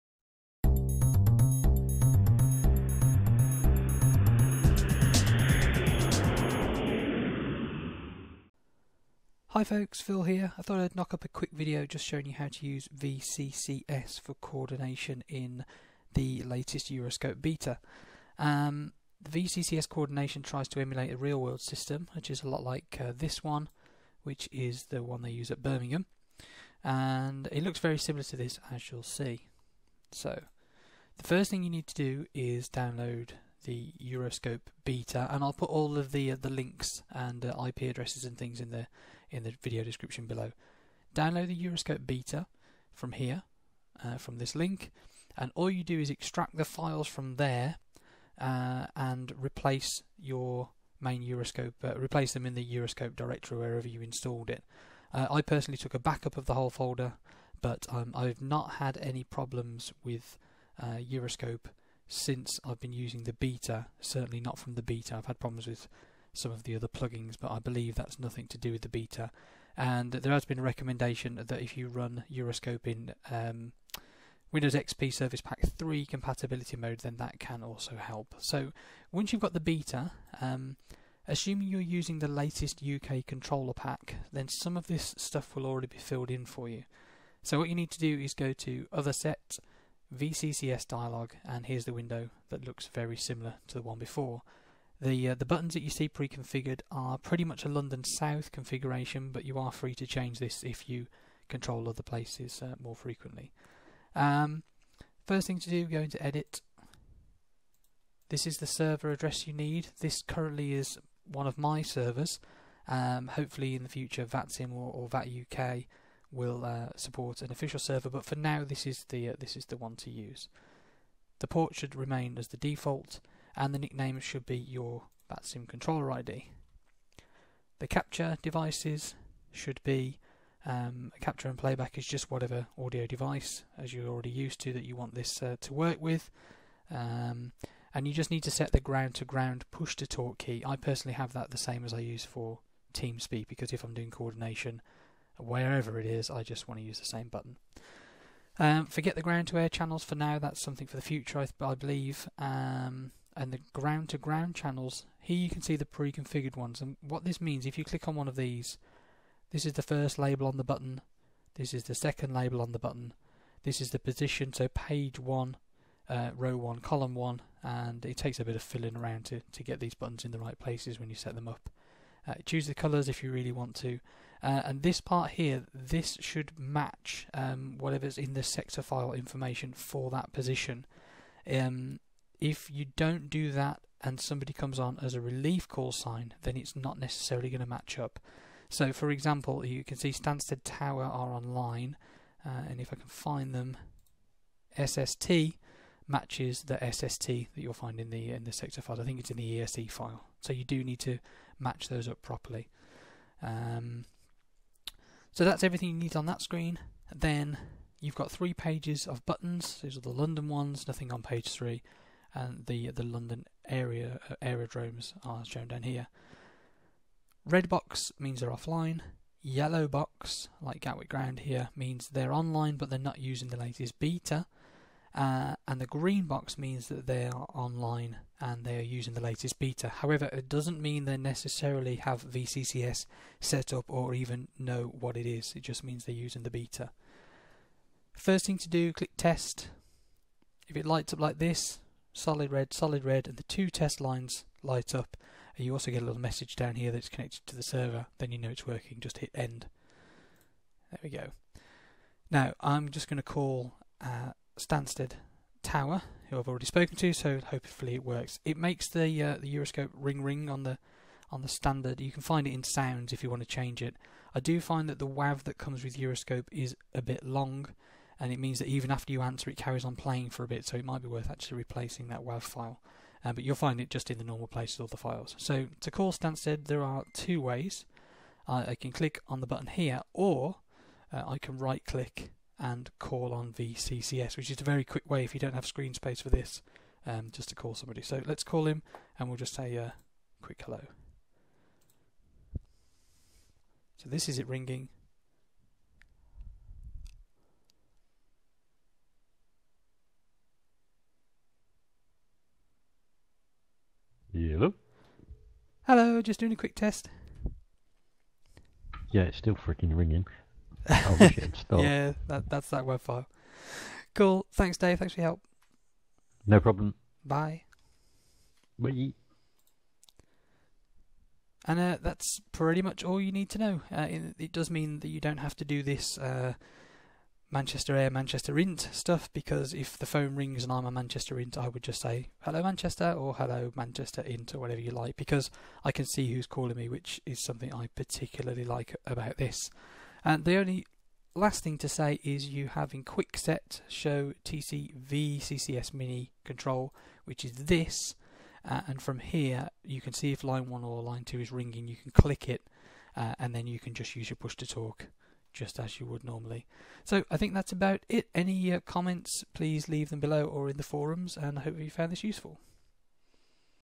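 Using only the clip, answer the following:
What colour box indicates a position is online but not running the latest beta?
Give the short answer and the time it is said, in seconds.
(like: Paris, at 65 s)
Yellow, at 219 s.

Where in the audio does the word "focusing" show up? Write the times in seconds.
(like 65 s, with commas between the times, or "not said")
not said.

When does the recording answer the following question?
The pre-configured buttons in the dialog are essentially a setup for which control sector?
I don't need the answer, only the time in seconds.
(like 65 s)
97 s.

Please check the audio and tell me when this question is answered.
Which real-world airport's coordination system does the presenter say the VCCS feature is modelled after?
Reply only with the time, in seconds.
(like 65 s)
25 s.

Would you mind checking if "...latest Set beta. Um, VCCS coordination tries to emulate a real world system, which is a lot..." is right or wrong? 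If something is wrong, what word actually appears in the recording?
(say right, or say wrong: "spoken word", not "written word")
wrong: "Euroscope", not "Set".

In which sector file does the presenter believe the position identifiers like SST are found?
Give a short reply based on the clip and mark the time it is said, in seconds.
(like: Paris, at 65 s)
ESE file, at 199 s.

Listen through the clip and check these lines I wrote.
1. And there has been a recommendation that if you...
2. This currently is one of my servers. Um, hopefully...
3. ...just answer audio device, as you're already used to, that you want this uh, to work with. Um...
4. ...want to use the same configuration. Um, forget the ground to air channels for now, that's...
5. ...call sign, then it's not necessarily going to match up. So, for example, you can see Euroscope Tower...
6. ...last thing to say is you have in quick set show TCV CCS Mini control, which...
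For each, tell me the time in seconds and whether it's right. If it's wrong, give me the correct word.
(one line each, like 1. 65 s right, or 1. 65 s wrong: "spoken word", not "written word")
1. 69 s right
2. 110 s right
3. 132 s wrong: "whatever", not "answer"
4. 146 s wrong: "button", not "configuration"
5. 185 s wrong: "Stansted", not "Euroscope"
6. 341 s right.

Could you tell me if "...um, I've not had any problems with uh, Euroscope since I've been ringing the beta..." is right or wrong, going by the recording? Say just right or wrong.
wrong.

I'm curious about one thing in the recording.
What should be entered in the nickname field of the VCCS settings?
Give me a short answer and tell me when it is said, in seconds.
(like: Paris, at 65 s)
VATSIM controller ID, at 125 s.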